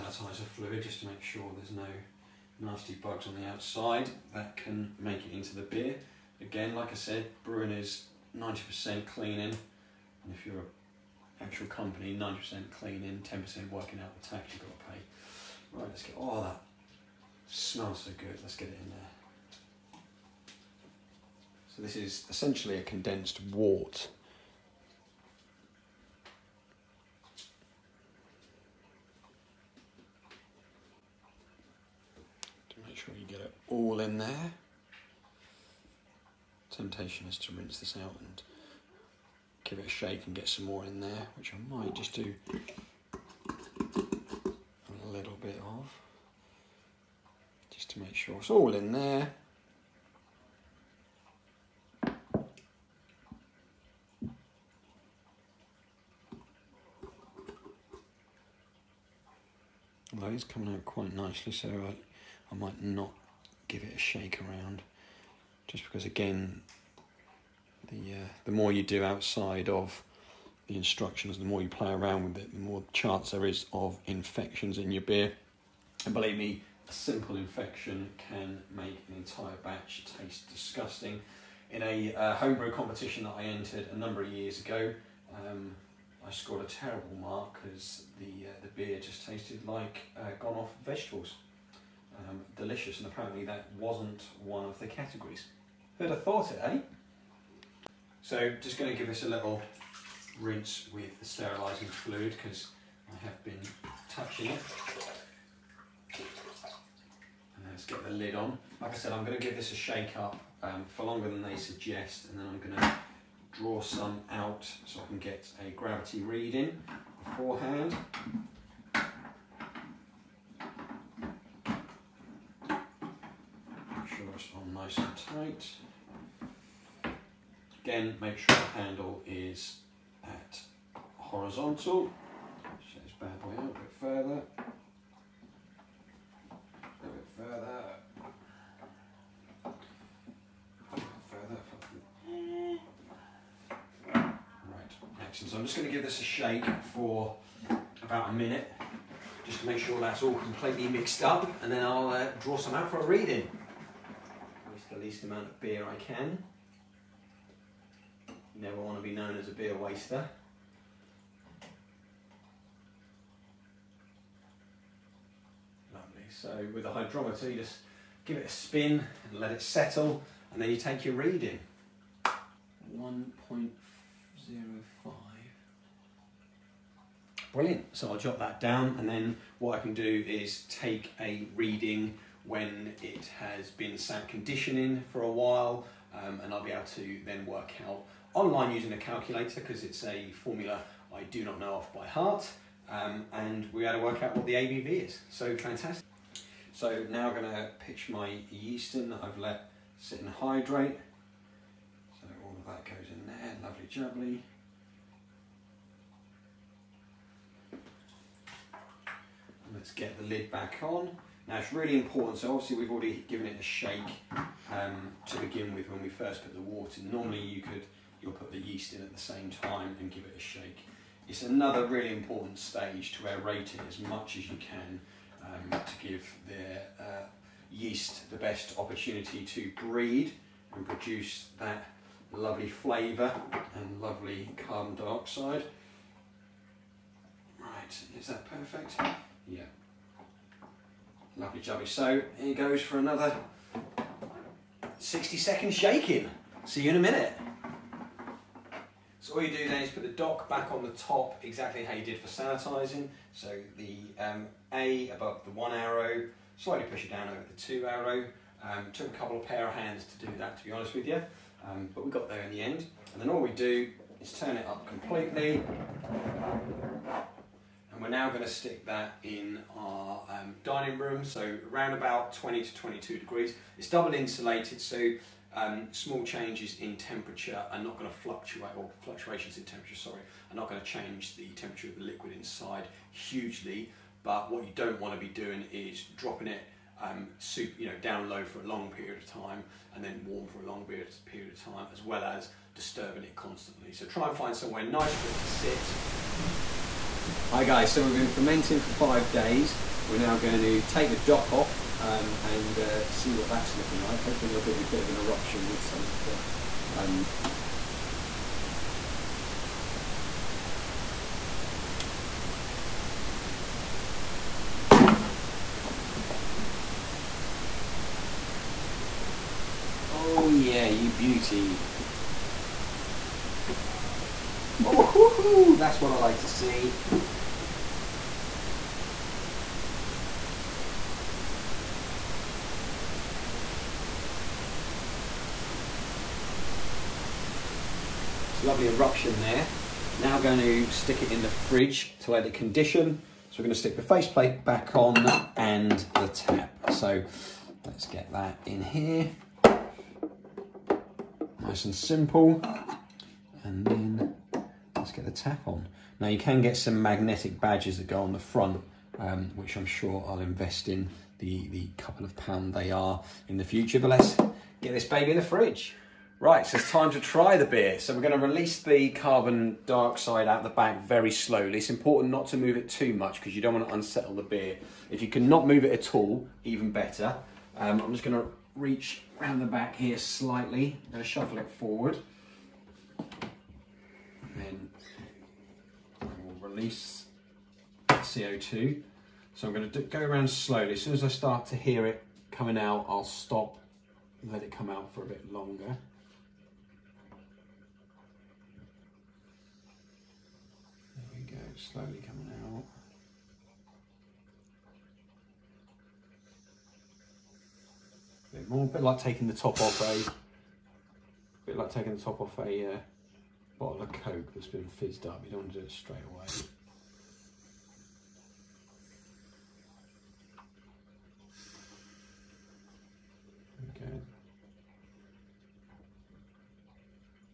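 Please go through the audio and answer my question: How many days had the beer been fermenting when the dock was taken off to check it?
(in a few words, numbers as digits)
5.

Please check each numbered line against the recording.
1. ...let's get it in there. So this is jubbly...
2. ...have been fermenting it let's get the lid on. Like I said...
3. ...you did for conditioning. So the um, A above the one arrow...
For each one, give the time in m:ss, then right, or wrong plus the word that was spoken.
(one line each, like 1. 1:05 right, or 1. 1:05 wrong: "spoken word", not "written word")
1. 0:18 wrong: "essentially", not "jubbly"
2. 1:43 wrong: "touching", not "fermenting"
3. 4:11 wrong: "sanitising", not "conditioning".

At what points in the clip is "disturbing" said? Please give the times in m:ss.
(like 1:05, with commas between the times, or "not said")
4:52.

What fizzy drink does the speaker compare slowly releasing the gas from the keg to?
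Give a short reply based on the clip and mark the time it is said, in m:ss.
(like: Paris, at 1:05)
Coke, at 6:54.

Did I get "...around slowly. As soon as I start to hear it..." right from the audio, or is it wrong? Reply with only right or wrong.
right.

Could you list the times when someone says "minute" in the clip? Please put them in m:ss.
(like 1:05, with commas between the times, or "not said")
2:28, 4:06.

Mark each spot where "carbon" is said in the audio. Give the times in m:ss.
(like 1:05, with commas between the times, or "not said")
3:54, 6:09.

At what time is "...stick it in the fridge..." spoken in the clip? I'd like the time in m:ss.
5:40.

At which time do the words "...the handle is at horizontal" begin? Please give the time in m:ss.
2:08.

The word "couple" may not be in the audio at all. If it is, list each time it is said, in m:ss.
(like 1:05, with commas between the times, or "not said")
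4:19, 6:01.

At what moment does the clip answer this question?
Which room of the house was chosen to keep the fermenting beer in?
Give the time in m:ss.
4:30.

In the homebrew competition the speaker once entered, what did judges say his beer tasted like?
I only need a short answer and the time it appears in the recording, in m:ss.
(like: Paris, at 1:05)
gone off vegetables, at 1:30.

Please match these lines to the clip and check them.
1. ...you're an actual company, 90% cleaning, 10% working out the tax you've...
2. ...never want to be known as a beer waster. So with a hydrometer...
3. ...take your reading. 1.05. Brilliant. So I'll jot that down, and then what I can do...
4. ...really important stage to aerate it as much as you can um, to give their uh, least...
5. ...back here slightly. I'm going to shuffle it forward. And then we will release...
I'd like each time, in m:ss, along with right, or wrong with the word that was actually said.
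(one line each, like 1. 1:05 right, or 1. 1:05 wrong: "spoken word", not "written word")
1. 0:10 right
2. 2:38 right
3. 2:50 right
4. 3:41 wrong: "yeast", not "least"
5. 6:19 right.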